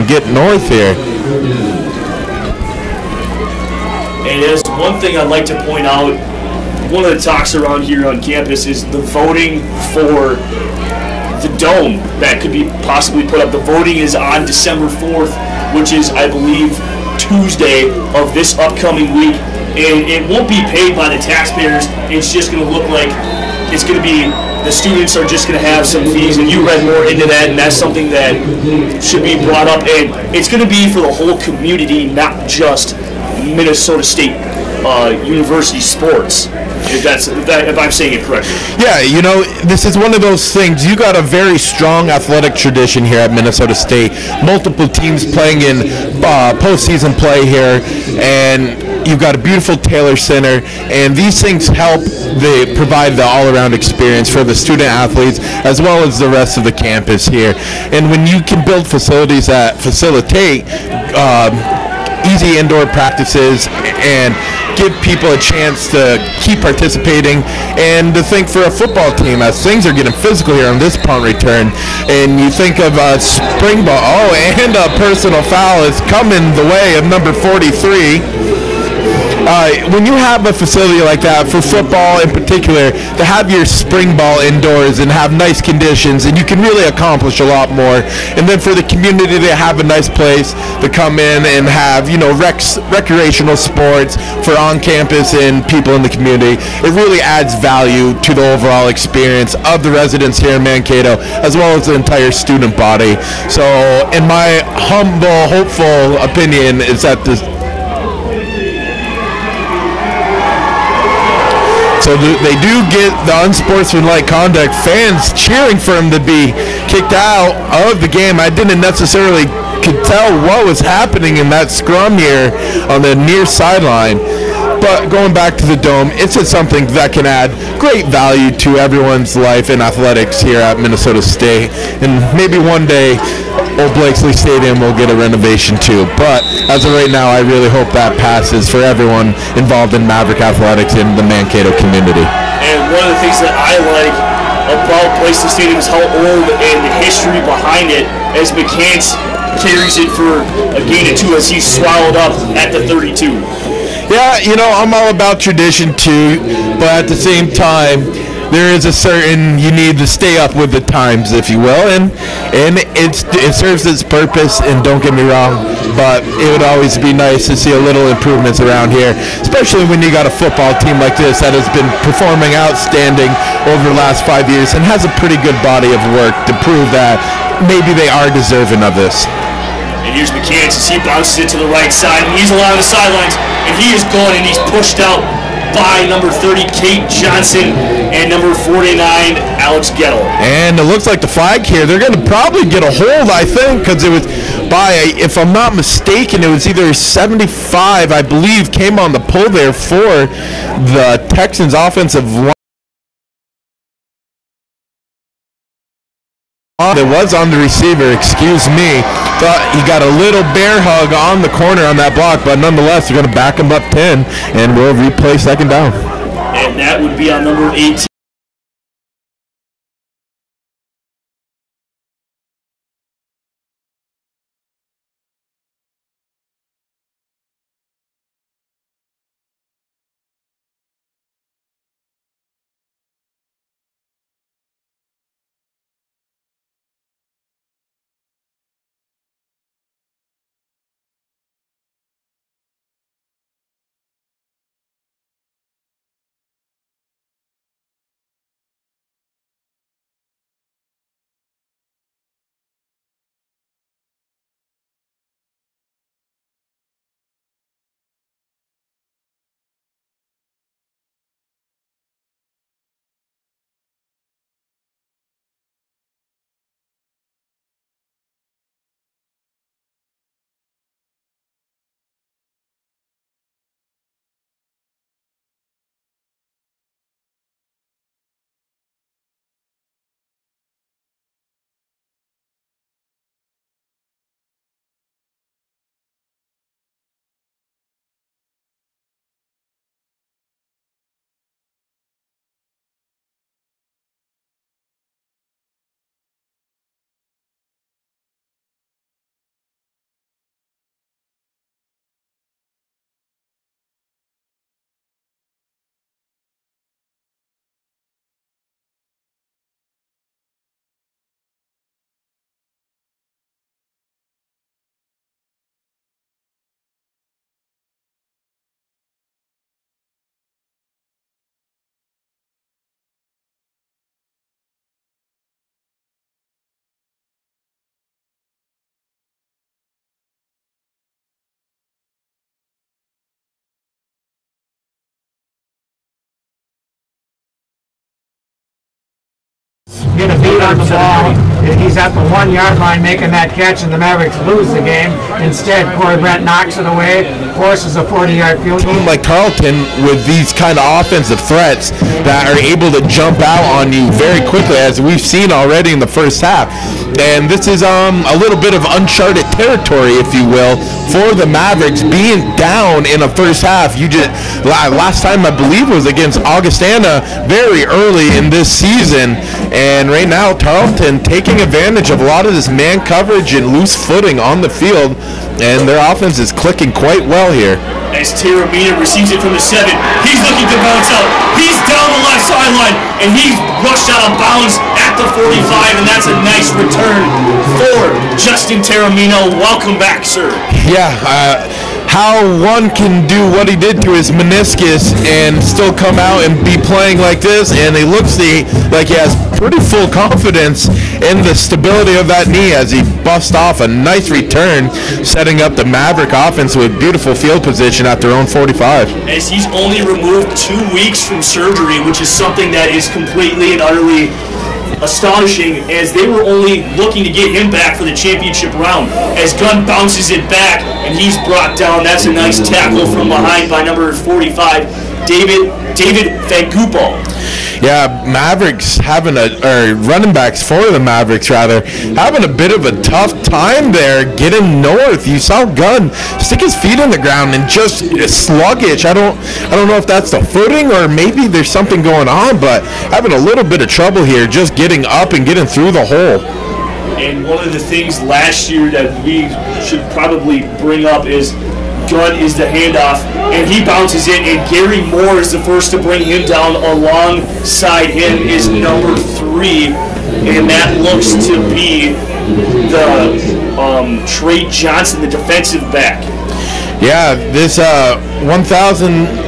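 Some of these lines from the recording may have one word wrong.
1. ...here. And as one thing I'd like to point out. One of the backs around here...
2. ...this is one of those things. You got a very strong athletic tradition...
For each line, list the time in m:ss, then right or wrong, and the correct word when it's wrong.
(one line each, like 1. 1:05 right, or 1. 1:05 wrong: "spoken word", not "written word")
1. 0:00 wrong: "talks", not "backs"
2. 0:39 right.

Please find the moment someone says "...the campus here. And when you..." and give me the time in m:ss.
0:56.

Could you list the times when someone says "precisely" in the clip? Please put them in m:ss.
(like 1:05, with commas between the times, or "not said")
not said.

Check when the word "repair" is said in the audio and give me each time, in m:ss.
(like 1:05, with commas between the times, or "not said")
not said.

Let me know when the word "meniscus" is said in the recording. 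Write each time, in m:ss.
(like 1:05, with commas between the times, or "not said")
6:34.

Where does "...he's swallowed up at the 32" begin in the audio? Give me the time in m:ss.
2:31.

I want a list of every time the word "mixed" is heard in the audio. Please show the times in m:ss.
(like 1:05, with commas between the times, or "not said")
not said.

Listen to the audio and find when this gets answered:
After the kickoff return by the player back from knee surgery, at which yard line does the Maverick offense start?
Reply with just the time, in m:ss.
6:48.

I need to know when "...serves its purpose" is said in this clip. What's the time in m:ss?
2:43.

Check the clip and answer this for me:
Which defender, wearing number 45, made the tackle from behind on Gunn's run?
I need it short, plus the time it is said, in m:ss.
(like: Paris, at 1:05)
David Fangupo, at 7:05.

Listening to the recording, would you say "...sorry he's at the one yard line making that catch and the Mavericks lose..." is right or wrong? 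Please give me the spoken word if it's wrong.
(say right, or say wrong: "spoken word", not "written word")
right.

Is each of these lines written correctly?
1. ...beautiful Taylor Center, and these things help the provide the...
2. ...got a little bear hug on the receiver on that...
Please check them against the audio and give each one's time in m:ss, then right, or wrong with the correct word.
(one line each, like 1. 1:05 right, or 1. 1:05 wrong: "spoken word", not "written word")
1. 0:49 right
2. 3:29 wrong: "corner", not "receiver".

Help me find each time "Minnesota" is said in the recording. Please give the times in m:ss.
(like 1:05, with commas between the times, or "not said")
0:33, 0:43, 2:10.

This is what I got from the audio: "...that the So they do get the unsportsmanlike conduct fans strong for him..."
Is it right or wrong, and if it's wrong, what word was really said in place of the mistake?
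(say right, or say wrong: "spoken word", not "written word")
wrong: "cheering", not "strong".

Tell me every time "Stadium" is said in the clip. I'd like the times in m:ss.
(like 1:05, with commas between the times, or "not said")
2:14, 2:25.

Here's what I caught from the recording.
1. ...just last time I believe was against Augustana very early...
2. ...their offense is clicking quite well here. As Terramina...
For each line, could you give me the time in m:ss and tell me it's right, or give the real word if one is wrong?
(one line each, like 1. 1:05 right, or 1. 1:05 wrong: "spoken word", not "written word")
1. 6:04 right
2. 6:15 right.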